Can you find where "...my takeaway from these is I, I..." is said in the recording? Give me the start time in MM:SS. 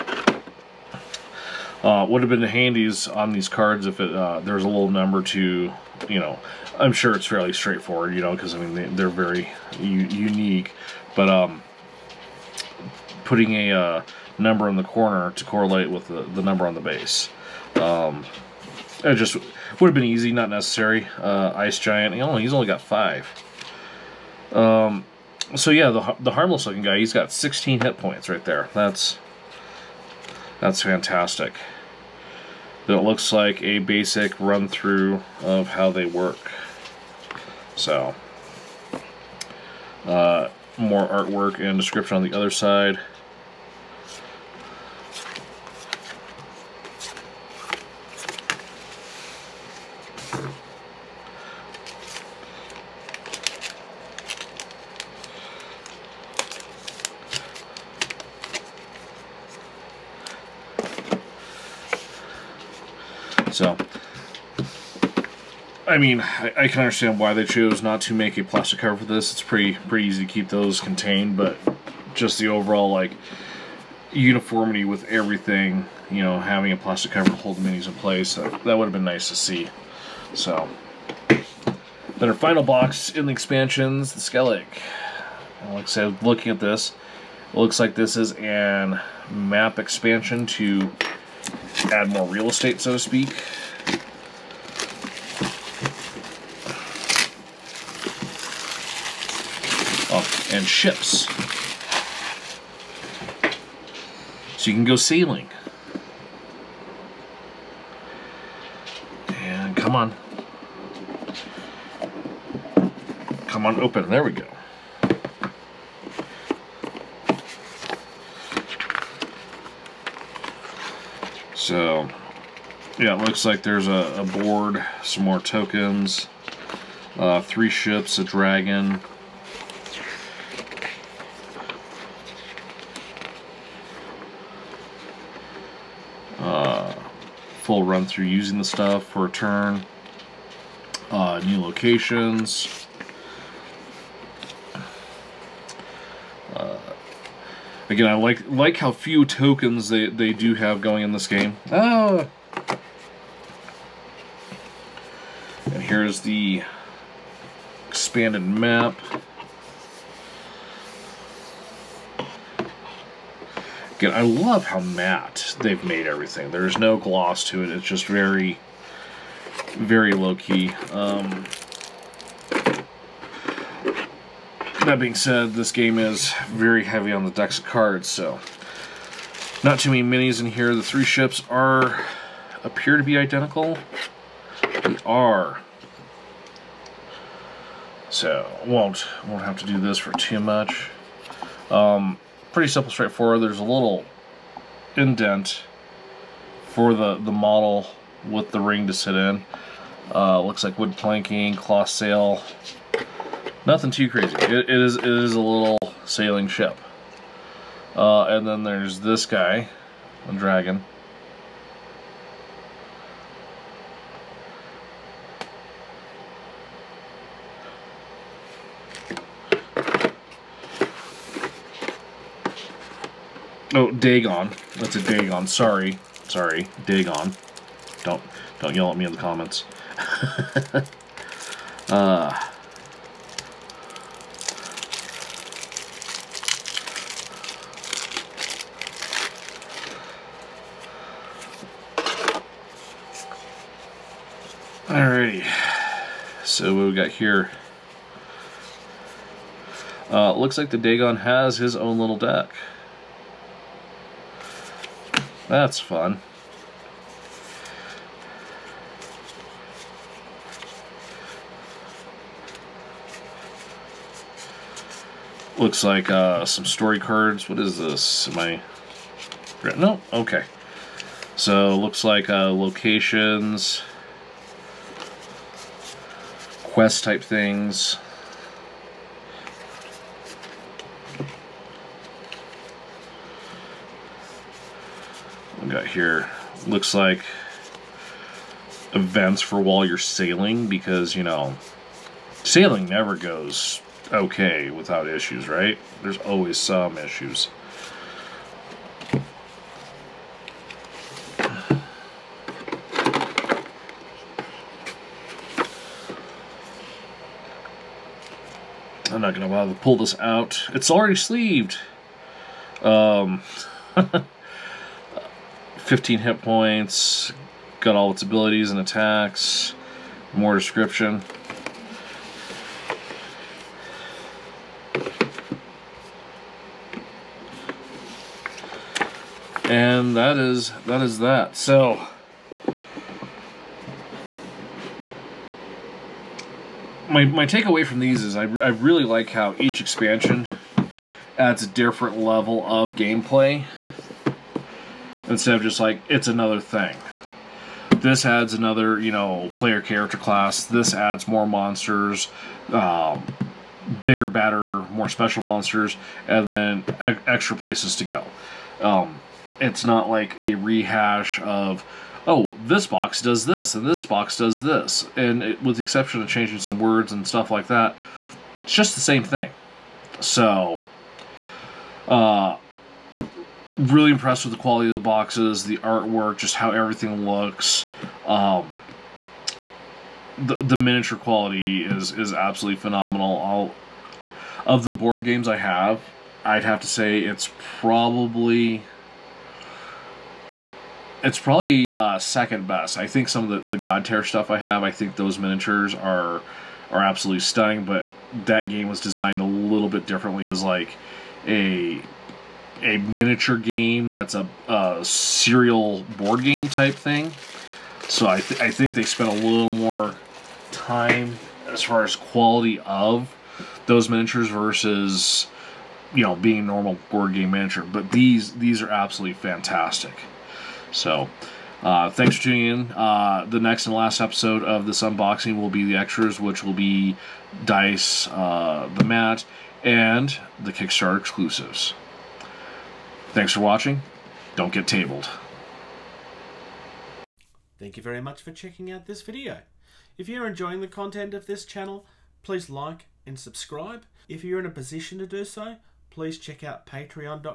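05:37.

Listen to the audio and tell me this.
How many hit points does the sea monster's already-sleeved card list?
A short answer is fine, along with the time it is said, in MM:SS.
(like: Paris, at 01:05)
15, at 05:15.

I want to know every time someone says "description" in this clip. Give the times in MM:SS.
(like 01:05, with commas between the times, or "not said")
00:41, 05:20.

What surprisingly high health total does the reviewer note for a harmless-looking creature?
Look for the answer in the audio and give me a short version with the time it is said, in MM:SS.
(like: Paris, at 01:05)
16, at 00:27.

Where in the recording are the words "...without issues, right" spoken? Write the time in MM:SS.
04:54.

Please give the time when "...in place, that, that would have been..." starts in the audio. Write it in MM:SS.
01:17.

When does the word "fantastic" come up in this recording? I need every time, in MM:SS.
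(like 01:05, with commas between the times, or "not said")
00:30, 06:59.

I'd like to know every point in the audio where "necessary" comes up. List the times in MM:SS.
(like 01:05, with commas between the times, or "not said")
00:20.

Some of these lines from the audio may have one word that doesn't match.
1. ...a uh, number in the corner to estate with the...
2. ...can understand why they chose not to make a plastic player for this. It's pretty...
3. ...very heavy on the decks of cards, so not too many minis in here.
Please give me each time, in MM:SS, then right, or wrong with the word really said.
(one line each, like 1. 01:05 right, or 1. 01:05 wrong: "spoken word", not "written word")
1. 00:13 wrong: "correlate", not "estate"
2. 01:06 wrong: "cover", not "player"
3. 02:56 right.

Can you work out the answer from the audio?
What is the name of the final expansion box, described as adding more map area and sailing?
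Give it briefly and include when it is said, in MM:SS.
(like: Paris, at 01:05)
Skellige, at 01:24.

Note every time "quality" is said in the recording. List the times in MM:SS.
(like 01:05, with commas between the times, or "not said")
06:14, 06:21, 06:52.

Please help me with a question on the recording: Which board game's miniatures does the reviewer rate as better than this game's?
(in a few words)
Godtear.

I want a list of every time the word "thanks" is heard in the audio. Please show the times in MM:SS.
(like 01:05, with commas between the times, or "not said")
07:02, 07:13, 07:17.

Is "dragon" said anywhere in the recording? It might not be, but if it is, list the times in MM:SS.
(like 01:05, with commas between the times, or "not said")
02:08, 03:30.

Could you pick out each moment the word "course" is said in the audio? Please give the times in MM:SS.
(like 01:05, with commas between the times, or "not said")
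not said.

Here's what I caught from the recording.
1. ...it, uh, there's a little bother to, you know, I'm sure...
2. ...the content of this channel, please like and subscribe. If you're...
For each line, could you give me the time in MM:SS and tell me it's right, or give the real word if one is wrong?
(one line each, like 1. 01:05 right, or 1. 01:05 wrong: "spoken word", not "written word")
1. 00:03 wrong: "number", not "bother"
2. 07:20 right.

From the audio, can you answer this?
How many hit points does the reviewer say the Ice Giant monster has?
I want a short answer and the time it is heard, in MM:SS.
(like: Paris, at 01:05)
5, at 00:22.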